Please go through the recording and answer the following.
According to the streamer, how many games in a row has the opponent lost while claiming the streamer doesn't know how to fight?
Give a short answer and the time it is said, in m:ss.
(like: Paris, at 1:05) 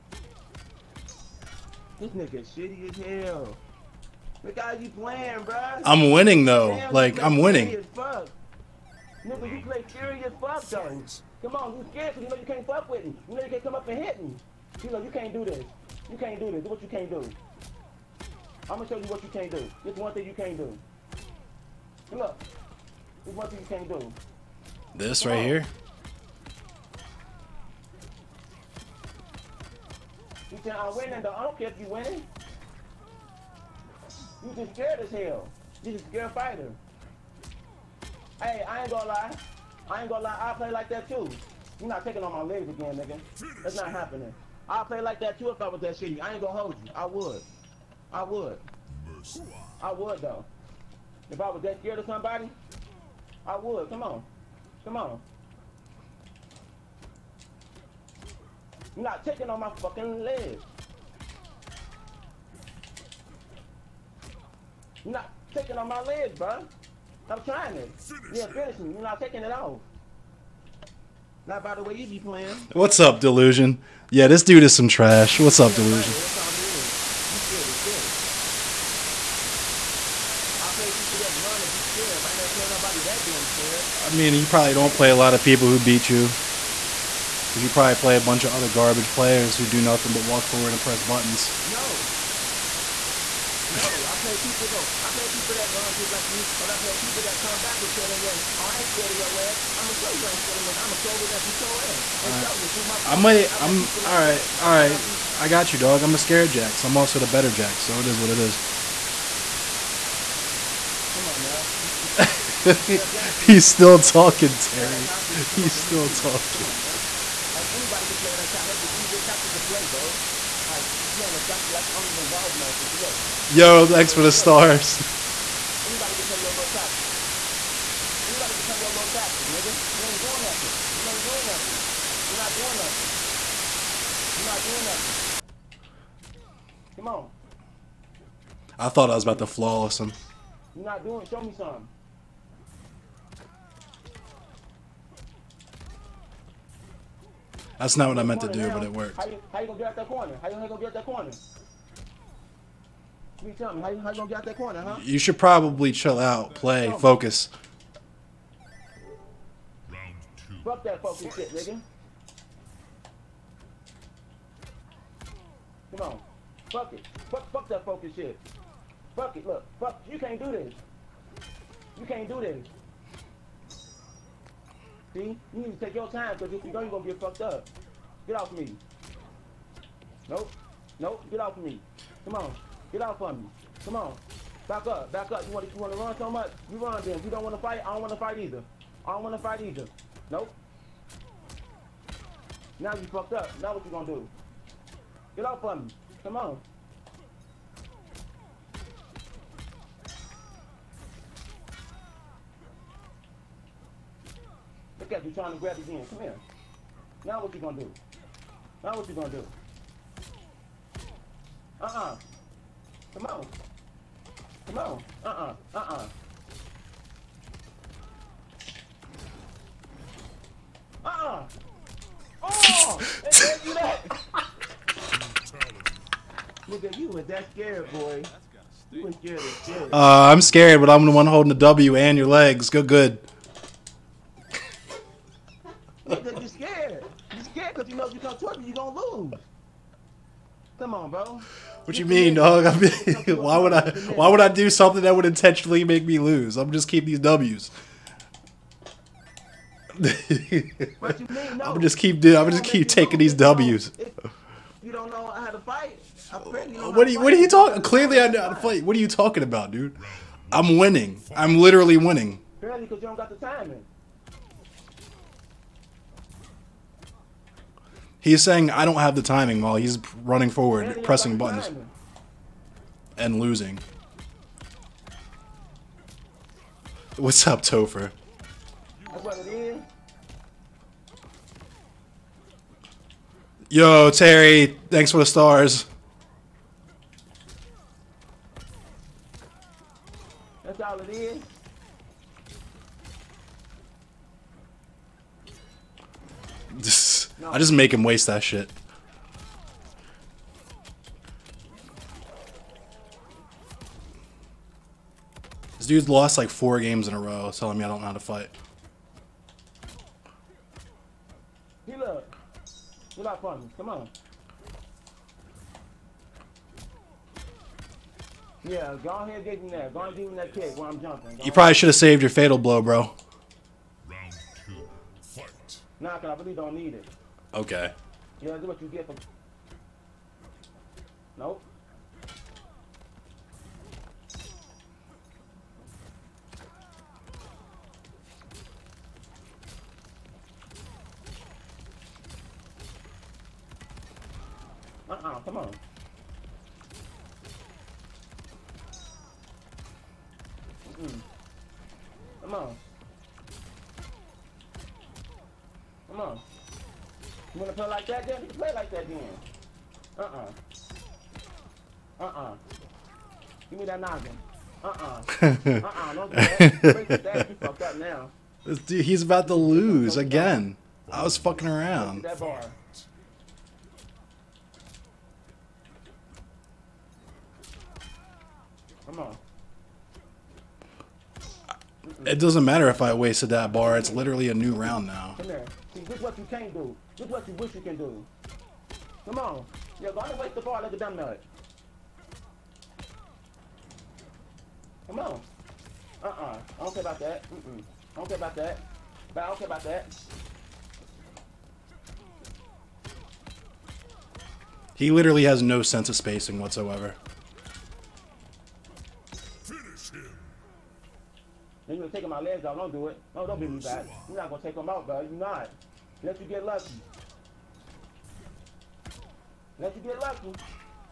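4, at 5:06.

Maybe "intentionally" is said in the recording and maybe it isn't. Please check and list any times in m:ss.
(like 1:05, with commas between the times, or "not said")
4:05.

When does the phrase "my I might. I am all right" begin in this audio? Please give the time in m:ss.
1:42.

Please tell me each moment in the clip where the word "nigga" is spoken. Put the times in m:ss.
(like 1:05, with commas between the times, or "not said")
0:02, 0:07, 0:42, 2:09, 2:41, 3:46.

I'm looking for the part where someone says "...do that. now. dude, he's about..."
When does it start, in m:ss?
6:06.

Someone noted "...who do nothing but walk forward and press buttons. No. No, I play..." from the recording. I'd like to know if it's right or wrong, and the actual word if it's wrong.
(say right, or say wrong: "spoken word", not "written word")
right.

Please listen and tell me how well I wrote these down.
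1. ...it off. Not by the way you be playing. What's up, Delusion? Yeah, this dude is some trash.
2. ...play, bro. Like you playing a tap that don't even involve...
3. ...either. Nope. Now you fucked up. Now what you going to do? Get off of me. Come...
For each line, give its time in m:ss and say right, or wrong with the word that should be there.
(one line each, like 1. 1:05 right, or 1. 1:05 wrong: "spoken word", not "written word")
1. 1:09 right
2. 1:59 right
3. 3:09 right.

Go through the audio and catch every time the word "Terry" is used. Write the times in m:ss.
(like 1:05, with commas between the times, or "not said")
1:54, 4:44.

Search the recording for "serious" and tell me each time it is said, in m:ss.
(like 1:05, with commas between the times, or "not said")
0:09.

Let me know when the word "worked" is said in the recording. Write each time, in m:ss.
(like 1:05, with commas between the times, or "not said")
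2:28.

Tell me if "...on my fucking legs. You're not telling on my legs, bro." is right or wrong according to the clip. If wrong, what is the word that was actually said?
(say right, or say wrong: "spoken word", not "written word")
wrong: "taking", not "telling".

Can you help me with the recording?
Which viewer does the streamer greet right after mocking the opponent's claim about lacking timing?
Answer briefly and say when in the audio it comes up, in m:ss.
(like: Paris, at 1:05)
Topher, at 4:37.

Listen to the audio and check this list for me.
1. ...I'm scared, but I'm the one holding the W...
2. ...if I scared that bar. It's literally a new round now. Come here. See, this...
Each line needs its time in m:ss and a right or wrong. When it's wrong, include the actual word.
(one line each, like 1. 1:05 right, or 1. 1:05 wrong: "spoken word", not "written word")
1. 3:50 right
2. 6:22 wrong: "wasted", not "scared".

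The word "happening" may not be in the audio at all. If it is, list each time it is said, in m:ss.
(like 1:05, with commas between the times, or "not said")
0:43.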